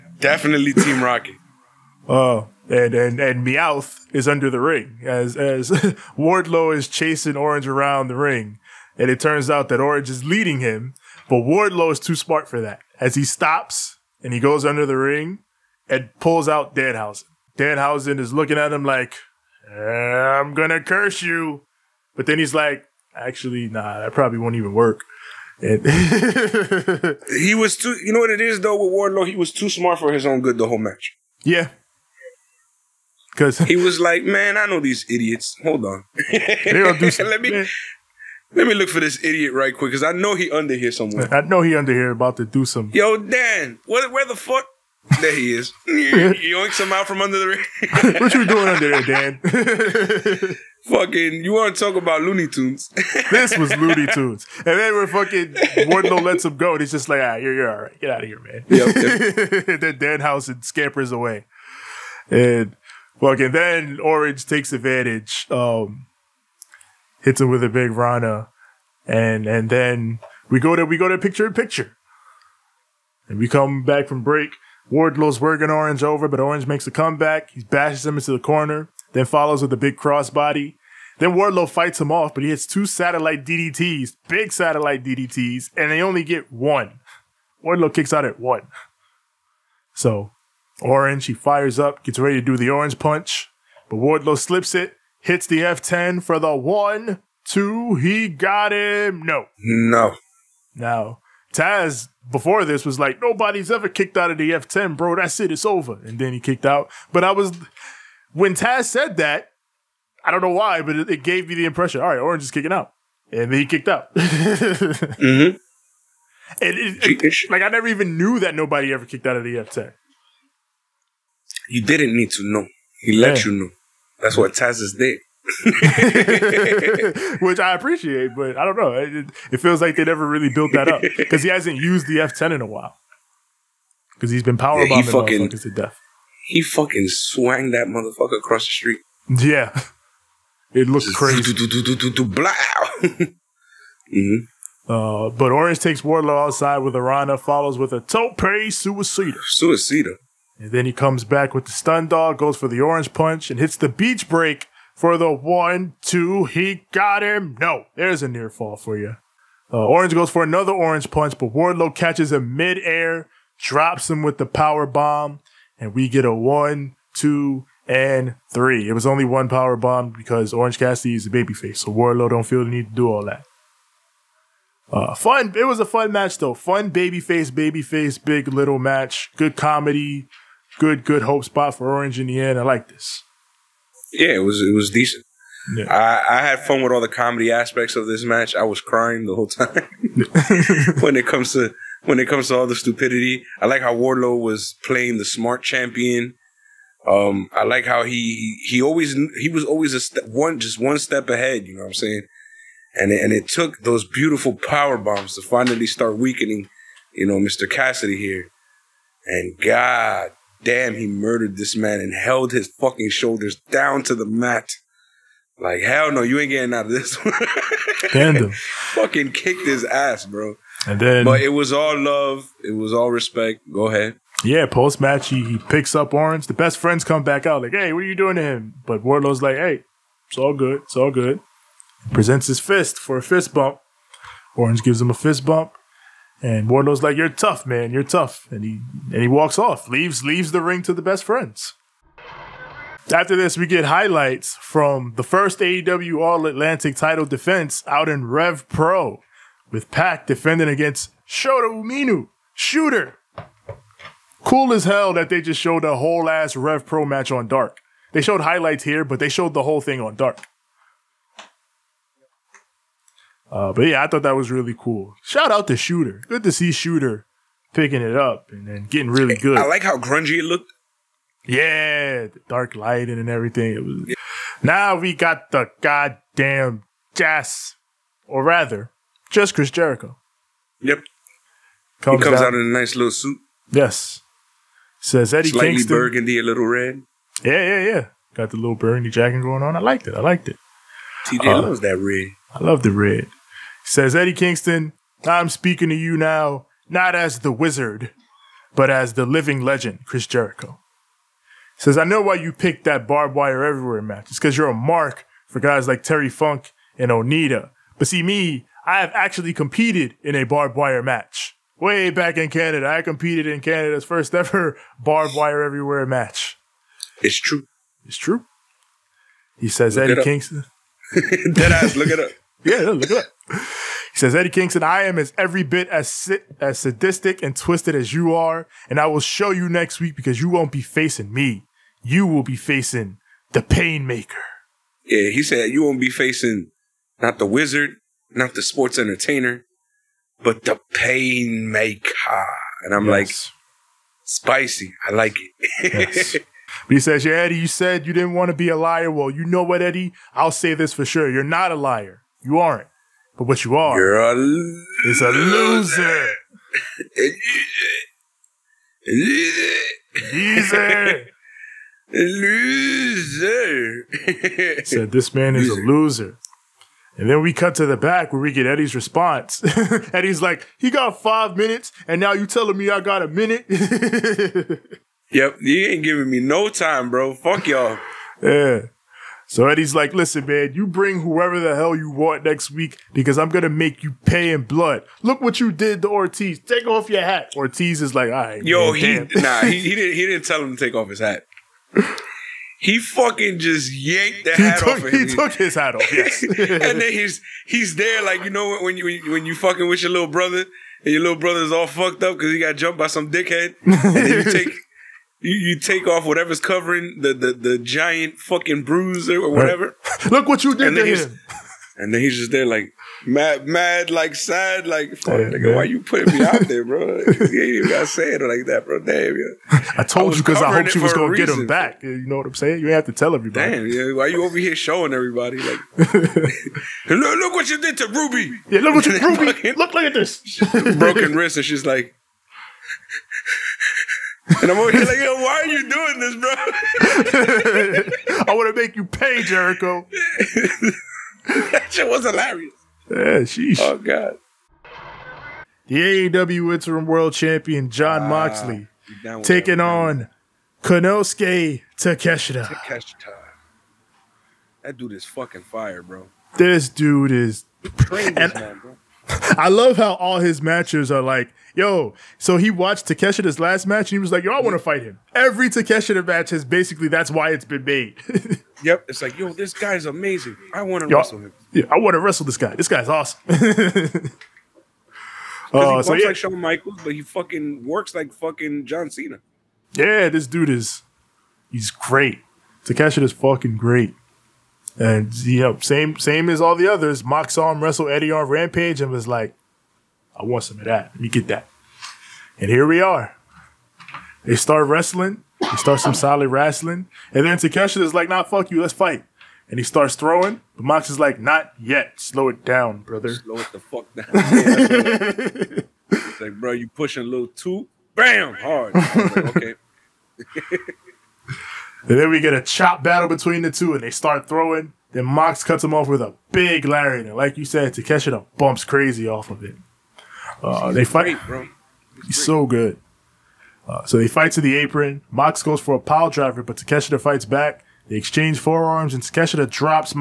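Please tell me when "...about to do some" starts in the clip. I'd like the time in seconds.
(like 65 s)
42 s.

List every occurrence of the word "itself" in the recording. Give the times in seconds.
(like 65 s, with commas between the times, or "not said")
not said.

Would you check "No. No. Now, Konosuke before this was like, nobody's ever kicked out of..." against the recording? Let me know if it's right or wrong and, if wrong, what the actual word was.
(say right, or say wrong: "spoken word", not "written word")
wrong: "Taz", not "Konosuke".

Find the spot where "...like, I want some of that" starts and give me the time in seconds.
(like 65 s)
489 s.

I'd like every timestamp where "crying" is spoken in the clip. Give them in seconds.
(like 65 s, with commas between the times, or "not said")
188 s.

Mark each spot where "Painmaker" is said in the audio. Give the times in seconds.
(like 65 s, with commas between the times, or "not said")
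333 s, 340 s.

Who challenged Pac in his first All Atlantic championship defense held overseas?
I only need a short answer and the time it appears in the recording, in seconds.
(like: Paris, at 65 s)
Shota Umino, at 251 s.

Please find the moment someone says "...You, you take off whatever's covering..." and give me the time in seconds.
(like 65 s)
405 s.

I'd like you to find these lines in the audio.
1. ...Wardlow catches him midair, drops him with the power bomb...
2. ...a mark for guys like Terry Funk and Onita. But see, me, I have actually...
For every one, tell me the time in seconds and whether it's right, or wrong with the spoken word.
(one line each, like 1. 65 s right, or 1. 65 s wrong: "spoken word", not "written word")
1. 161 s right
2. 304 s right.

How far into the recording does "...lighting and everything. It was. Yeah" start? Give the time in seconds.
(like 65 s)
272 s.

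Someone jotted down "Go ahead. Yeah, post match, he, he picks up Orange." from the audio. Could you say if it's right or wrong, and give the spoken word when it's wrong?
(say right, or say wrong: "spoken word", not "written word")
right.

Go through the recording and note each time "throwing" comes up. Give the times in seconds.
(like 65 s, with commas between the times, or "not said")
500 s, 514 s.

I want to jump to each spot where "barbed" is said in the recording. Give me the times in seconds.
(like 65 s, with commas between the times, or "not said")
303 s, 310 s, 315 s.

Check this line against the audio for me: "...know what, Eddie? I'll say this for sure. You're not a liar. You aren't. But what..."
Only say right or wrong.
right.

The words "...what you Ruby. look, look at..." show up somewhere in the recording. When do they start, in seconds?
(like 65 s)
428 s.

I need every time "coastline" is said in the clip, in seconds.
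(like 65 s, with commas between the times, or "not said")
not said.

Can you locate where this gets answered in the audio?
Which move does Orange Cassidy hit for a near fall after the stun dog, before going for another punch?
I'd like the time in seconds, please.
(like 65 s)
153 s.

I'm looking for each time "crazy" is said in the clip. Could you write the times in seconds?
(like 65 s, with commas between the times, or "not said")
141 s, 518 s.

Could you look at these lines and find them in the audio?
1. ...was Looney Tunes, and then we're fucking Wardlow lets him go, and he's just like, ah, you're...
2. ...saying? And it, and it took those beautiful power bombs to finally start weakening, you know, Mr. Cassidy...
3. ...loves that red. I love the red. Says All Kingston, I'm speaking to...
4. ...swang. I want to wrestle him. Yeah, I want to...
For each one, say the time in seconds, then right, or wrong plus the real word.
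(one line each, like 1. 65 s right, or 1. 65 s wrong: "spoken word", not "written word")
1. 53 s right
2. 201 s right
3. 291 s wrong: "Eddie", not "All"
4. 470 s wrong: "amazing", not "swang".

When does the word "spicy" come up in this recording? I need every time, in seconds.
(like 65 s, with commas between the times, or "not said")
344 s.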